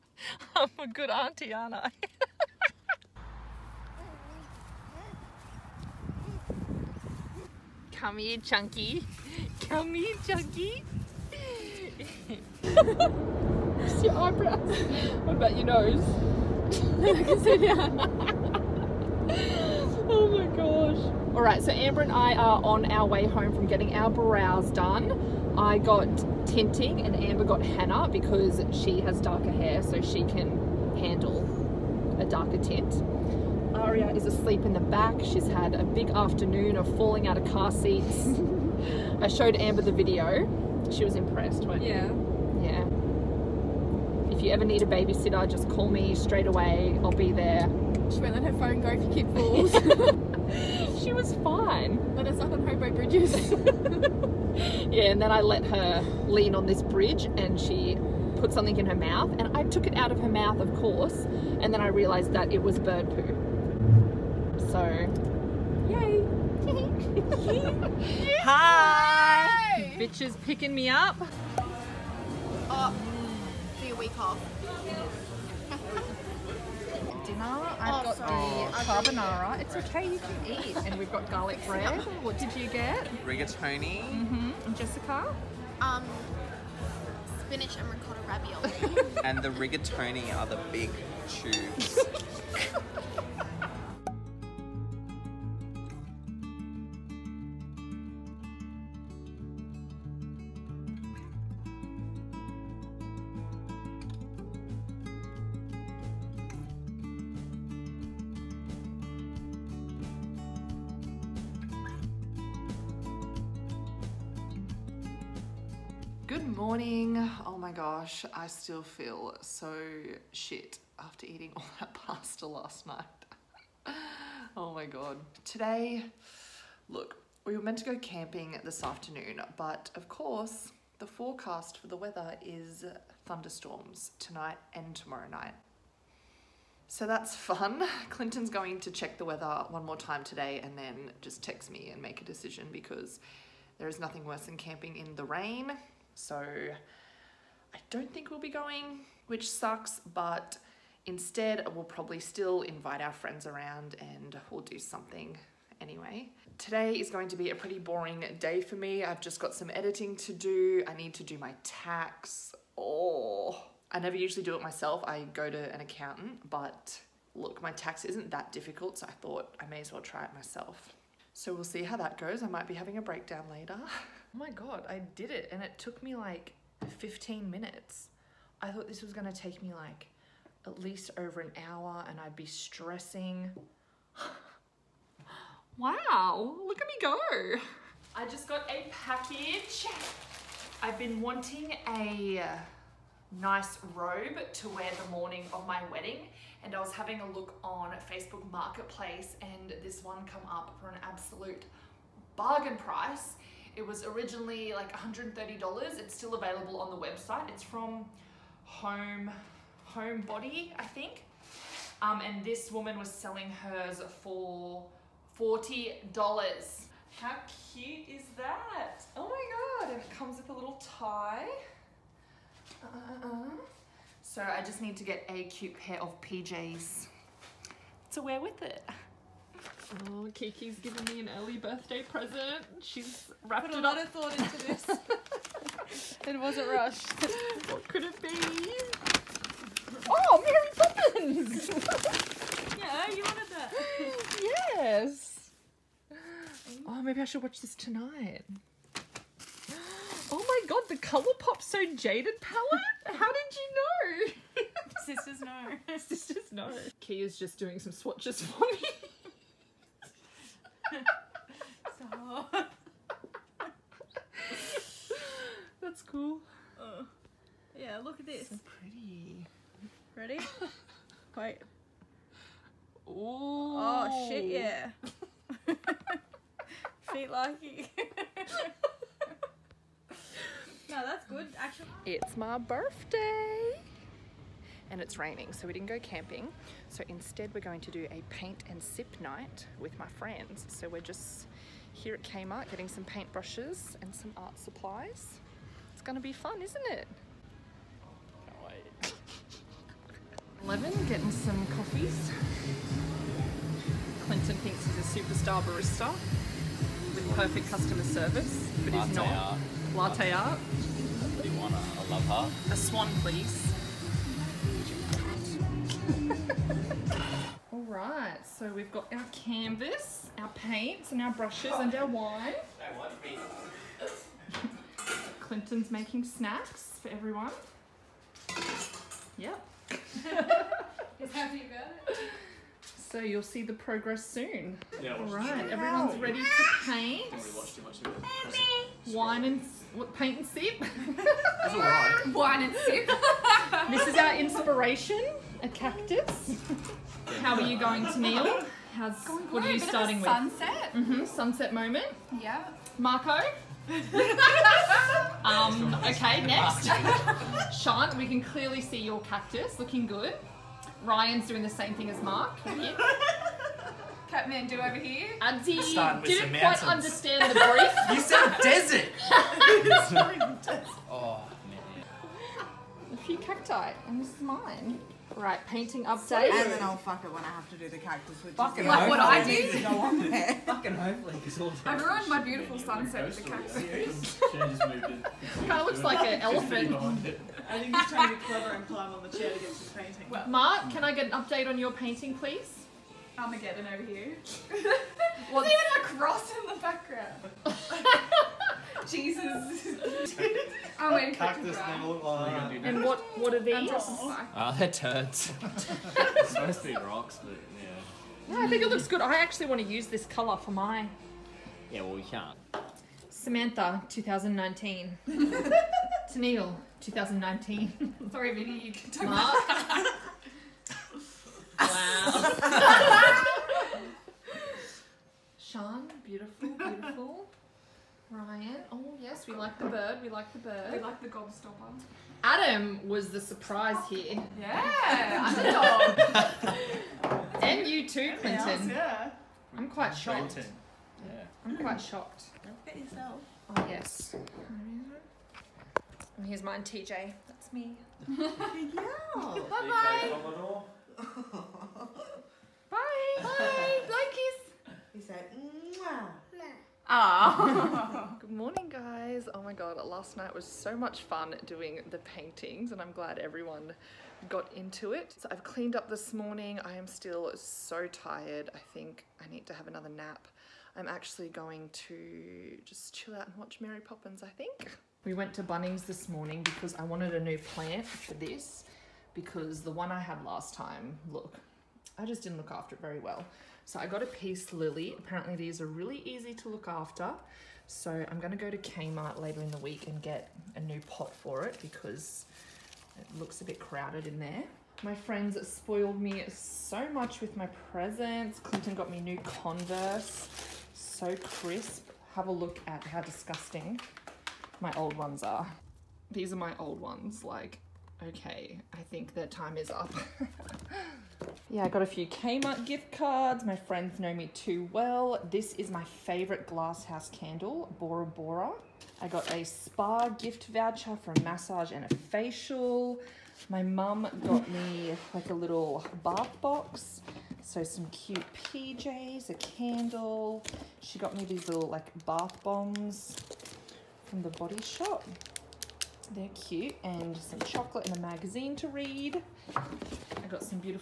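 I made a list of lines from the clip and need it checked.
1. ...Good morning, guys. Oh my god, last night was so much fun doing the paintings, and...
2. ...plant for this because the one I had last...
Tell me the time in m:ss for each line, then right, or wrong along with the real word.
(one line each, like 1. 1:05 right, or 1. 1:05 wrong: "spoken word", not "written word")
1. 7:38 right
2. 7:57 right.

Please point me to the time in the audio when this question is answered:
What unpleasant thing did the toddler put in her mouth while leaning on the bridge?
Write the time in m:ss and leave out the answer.
1:02.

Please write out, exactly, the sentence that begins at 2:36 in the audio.
Today is going to be a pretty boring day for me.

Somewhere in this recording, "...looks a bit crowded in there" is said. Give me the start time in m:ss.
8:13.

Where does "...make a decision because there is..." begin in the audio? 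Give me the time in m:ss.
2:22.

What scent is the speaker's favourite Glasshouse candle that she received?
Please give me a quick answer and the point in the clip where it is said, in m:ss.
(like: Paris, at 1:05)
Bora Bora, at 8:37.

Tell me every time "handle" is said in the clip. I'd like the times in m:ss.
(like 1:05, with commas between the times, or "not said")
0:30.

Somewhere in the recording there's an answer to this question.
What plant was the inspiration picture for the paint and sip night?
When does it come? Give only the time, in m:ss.
5:45.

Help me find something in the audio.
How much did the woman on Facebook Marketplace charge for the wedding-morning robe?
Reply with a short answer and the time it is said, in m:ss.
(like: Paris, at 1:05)
$40, at 3:35.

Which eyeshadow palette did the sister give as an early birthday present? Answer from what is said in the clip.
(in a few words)
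Colourpop So Jaded.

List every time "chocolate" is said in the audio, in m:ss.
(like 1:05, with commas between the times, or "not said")
8:57.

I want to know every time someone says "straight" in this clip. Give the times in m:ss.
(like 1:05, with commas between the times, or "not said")
0:46.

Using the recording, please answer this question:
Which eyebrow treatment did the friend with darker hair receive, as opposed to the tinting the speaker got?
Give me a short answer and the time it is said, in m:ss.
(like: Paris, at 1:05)
Henna, at 0:27.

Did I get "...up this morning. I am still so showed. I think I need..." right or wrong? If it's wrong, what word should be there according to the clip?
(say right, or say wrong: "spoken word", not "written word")
wrong: "tired", not "showed".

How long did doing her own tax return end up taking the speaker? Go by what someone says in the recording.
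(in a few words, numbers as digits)
15 minutes.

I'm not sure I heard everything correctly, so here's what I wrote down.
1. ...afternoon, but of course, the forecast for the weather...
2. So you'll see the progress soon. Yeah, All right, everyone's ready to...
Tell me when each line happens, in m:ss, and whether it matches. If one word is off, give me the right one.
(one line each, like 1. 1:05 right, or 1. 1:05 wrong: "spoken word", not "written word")
1. 2:08 right
2. 5:33 right.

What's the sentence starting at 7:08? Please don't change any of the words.
Ryan, oh yes, we like the bird, we like the bird.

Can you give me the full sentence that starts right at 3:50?
Oh, Kiki's giving me an early birthday present.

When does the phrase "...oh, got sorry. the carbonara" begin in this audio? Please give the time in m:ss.
1:18.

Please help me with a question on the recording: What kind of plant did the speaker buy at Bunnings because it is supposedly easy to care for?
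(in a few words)
Peace lily.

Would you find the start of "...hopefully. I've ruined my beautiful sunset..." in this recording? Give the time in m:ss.
6:20.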